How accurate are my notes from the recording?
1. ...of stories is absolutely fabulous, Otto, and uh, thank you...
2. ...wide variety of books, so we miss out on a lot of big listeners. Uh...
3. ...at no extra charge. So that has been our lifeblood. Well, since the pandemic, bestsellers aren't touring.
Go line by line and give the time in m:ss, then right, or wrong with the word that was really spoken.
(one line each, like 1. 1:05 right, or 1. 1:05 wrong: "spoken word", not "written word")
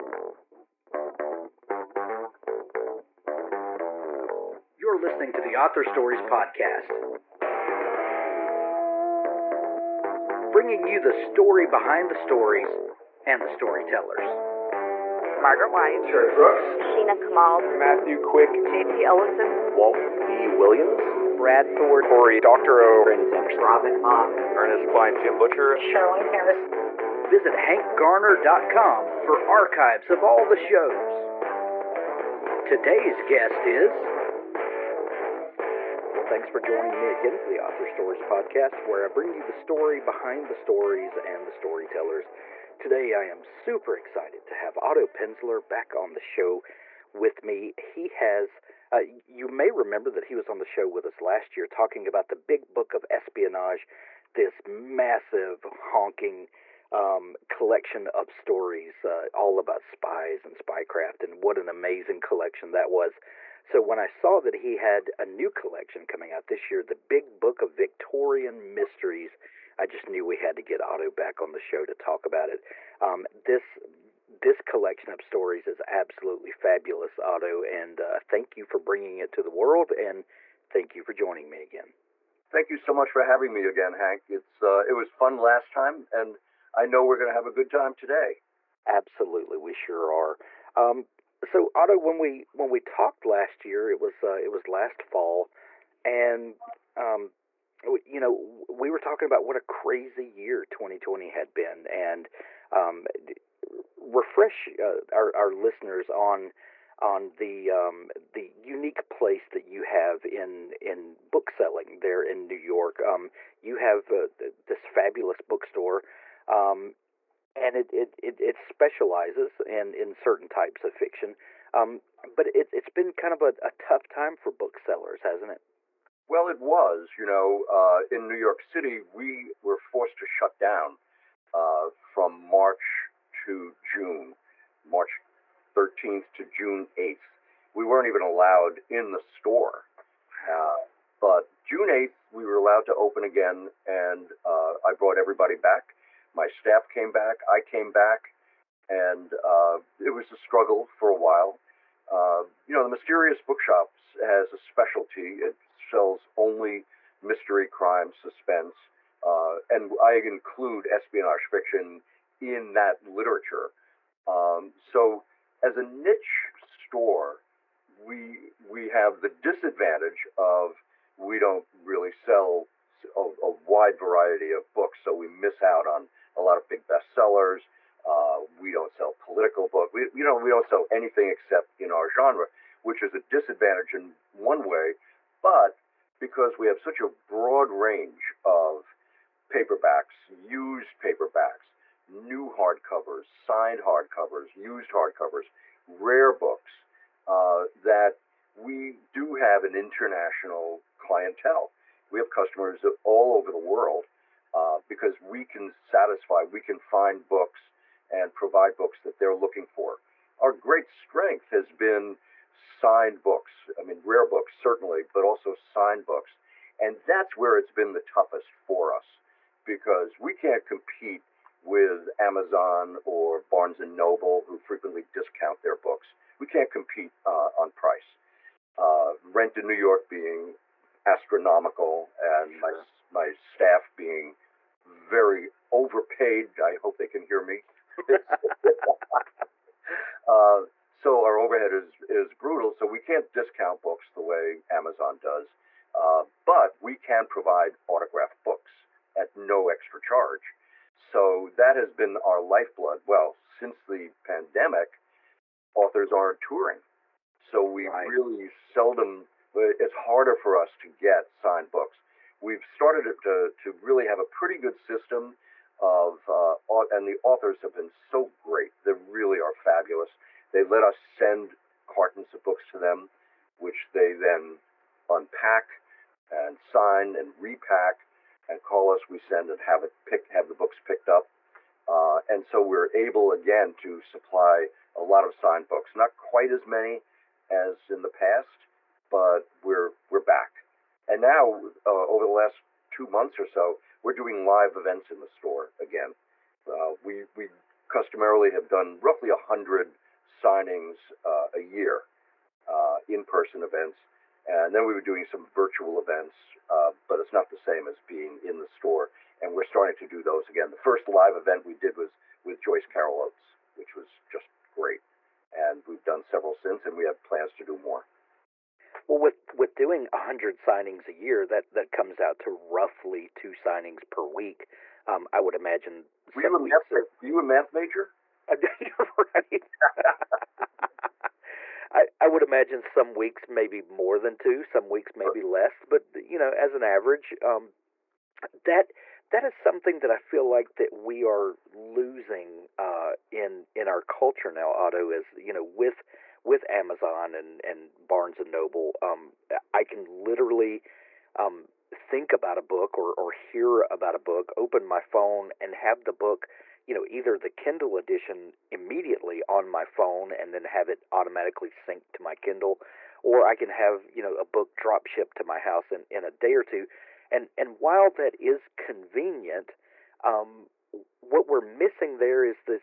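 1. 1:15 right
2. 2:53 wrong: "bestsellers", not "listeners"
3. 4:09 wrong: "authors", not "bestsellers".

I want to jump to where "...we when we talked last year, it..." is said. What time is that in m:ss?
1:32.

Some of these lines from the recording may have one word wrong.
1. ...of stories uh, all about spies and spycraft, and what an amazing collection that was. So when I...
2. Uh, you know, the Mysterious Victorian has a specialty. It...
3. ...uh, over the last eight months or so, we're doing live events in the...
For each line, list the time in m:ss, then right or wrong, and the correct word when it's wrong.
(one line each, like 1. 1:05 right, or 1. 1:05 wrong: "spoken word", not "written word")
1. 0:58 right
2. 2:32 wrong: "Bookshops", not "Victorian"
3. 4:51 wrong: "two", not "eight".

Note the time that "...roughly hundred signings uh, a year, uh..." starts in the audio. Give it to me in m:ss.
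4:59.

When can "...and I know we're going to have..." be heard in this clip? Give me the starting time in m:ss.
1:26.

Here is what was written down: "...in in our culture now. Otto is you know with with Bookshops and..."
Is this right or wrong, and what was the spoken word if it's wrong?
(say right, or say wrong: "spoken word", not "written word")
wrong: "Amazon", not "Bookshops".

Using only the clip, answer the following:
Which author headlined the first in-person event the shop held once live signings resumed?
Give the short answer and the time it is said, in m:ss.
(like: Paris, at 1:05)
Joyce Carol Oates, at 5:12.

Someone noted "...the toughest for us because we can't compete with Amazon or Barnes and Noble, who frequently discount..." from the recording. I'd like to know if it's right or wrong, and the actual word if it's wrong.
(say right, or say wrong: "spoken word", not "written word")
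right.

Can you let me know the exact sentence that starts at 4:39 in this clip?
We send and have it pick, have the books picked up.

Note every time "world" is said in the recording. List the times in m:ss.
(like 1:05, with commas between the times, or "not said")
1:19, 3:23.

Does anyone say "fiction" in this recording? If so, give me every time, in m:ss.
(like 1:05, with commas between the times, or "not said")
2:00, 2:41.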